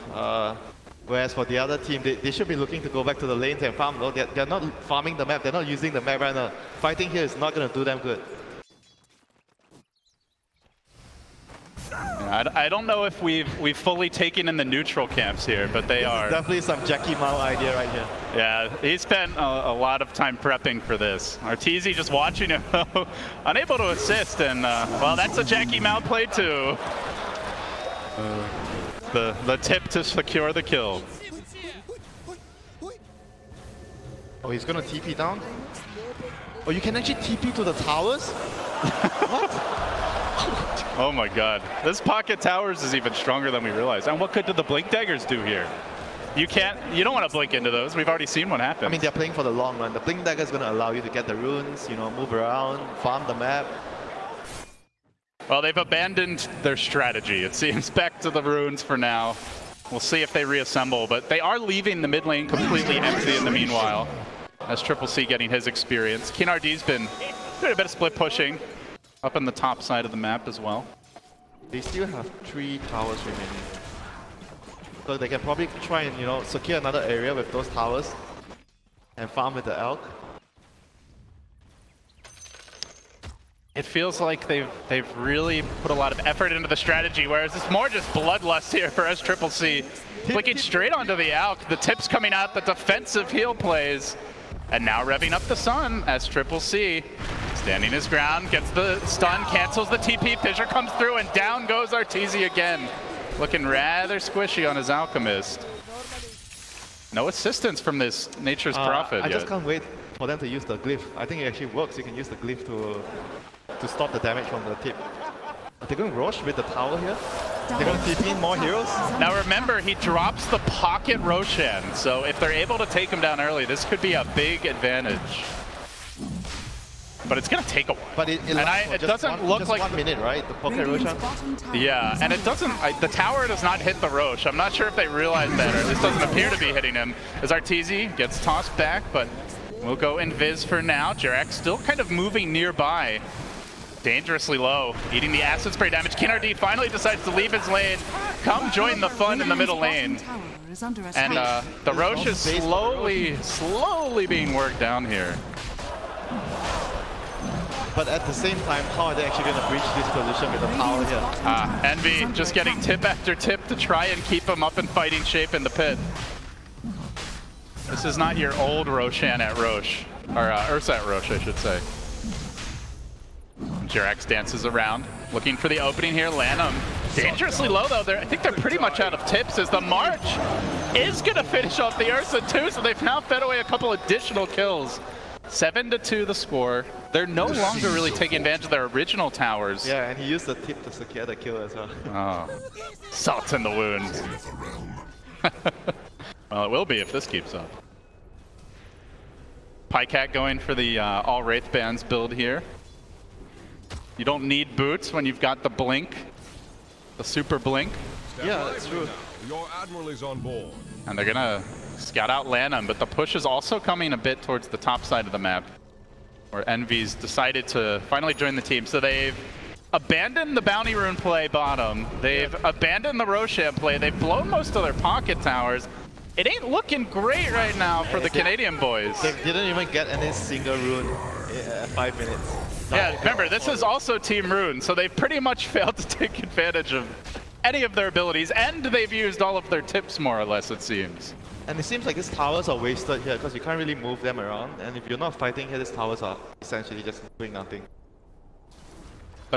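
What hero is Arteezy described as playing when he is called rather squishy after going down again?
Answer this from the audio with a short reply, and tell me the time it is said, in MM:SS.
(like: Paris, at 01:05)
Alchemist, at 01:44.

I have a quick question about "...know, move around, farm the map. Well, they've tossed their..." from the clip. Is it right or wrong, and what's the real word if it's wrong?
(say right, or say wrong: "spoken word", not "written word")
wrong: "abandoned", not "tossed".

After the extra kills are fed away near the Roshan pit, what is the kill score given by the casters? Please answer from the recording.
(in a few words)
7 to 2.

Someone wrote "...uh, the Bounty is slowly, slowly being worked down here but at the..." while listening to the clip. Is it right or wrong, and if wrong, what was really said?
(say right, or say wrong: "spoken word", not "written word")
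wrong: "Rosh", not "Bounty".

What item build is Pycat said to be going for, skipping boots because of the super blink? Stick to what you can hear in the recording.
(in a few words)
All Wraith Bands.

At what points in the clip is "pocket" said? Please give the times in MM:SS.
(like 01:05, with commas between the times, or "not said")
00:41, 02:00, 03:44.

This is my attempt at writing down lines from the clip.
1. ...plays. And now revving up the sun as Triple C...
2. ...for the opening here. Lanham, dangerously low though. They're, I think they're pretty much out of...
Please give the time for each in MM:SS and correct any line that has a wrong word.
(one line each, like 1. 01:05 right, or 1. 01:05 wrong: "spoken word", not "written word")
1. 01:33 right
2. 02:55 right.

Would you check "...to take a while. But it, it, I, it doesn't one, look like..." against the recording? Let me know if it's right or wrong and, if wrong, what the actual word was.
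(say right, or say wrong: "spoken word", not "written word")
right.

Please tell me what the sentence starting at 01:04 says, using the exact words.
That's Triple C getting his experience.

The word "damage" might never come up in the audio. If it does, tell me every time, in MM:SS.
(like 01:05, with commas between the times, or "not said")
01:54, 02:25.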